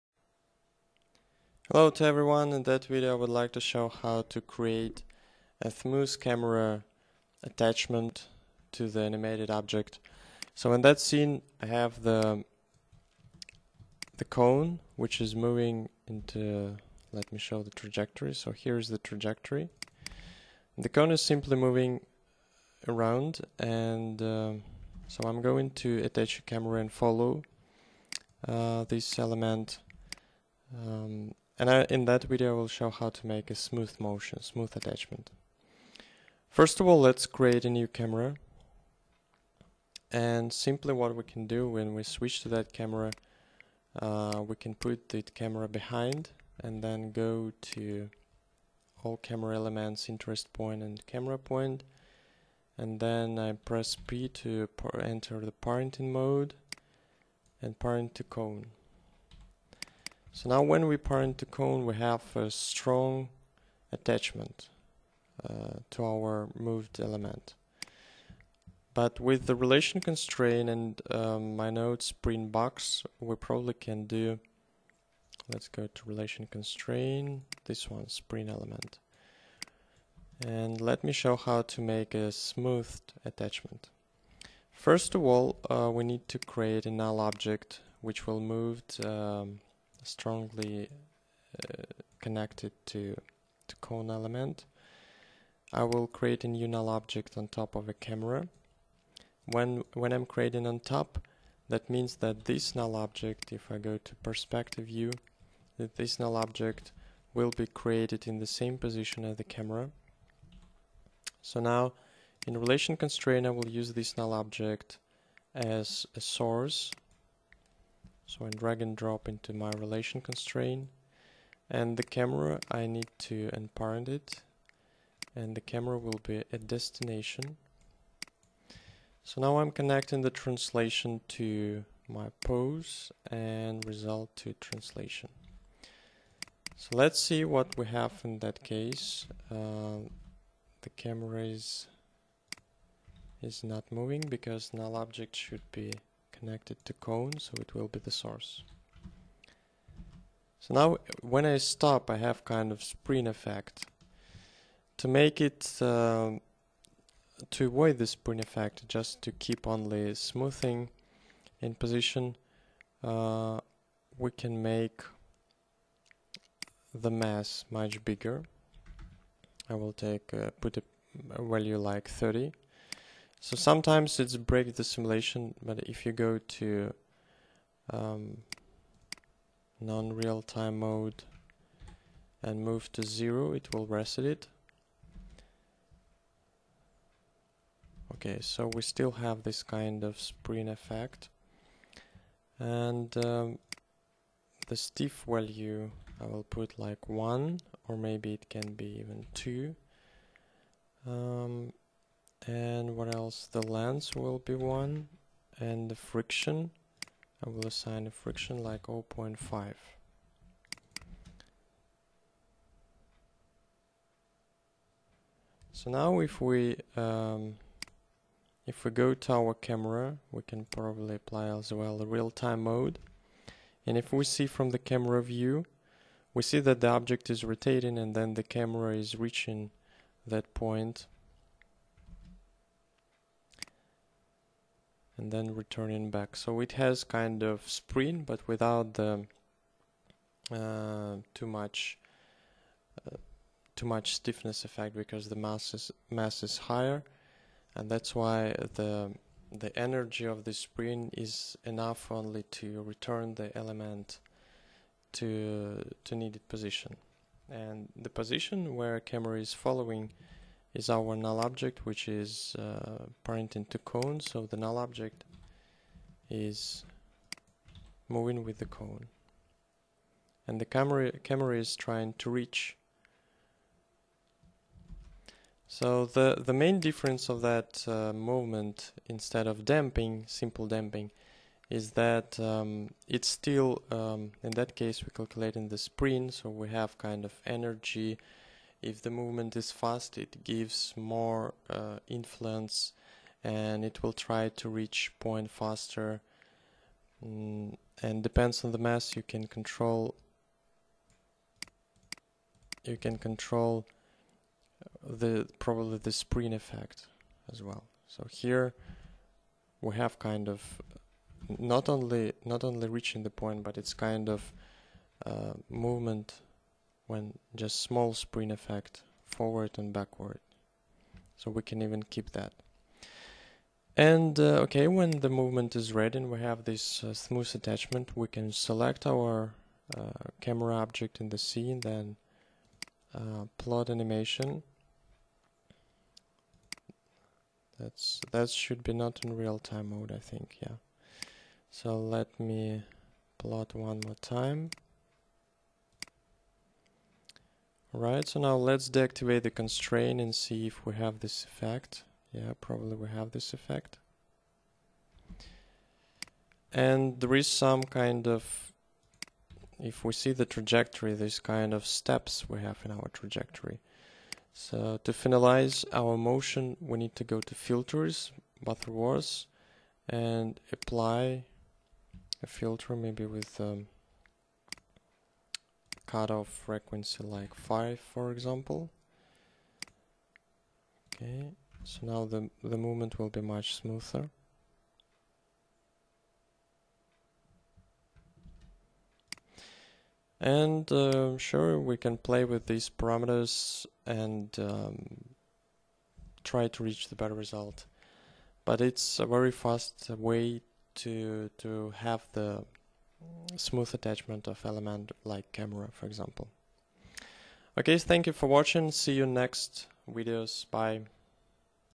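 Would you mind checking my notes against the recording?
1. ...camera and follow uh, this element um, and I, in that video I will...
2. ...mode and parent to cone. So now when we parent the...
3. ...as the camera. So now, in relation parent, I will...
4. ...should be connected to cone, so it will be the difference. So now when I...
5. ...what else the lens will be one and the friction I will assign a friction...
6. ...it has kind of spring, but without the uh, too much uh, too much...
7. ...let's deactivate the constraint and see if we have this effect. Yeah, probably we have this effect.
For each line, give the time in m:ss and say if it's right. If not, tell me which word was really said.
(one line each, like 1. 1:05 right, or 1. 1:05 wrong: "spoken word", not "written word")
1. 0:26 right
2. 0:56 right
3. 1:49 wrong: "constraint", not "parent"
4. 2:25 wrong: "source", not "difference"
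5. 3:22 right
6. 3:56 right
7. 5:48 right.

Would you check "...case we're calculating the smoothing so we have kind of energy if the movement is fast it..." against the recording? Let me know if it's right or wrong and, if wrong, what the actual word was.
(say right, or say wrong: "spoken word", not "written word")
wrong: "spring", not "smoothing".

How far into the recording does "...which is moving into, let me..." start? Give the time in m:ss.
0:14.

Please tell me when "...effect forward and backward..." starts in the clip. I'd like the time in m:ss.
5:18.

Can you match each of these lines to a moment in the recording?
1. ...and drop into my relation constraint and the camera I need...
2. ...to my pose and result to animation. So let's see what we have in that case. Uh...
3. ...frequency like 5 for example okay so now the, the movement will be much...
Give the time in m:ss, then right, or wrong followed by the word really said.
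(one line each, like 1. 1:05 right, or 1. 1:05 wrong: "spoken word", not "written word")
1. 1:58 right
2. 2:11 wrong: "translation", not "animation"
3. 6:16 right.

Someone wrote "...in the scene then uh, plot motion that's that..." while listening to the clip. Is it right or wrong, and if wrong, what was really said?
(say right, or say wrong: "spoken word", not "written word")
wrong: "animation", not "motion".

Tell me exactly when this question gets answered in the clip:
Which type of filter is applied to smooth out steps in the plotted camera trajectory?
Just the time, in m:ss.
6:08.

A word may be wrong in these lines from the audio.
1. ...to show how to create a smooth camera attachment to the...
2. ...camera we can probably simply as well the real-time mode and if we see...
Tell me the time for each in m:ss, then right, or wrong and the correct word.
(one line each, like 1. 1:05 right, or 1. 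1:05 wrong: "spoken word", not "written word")
1. 0:03 right
2. 3:39 wrong: "apply", not "simply".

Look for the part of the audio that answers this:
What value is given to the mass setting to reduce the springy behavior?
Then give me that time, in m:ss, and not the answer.
2:52.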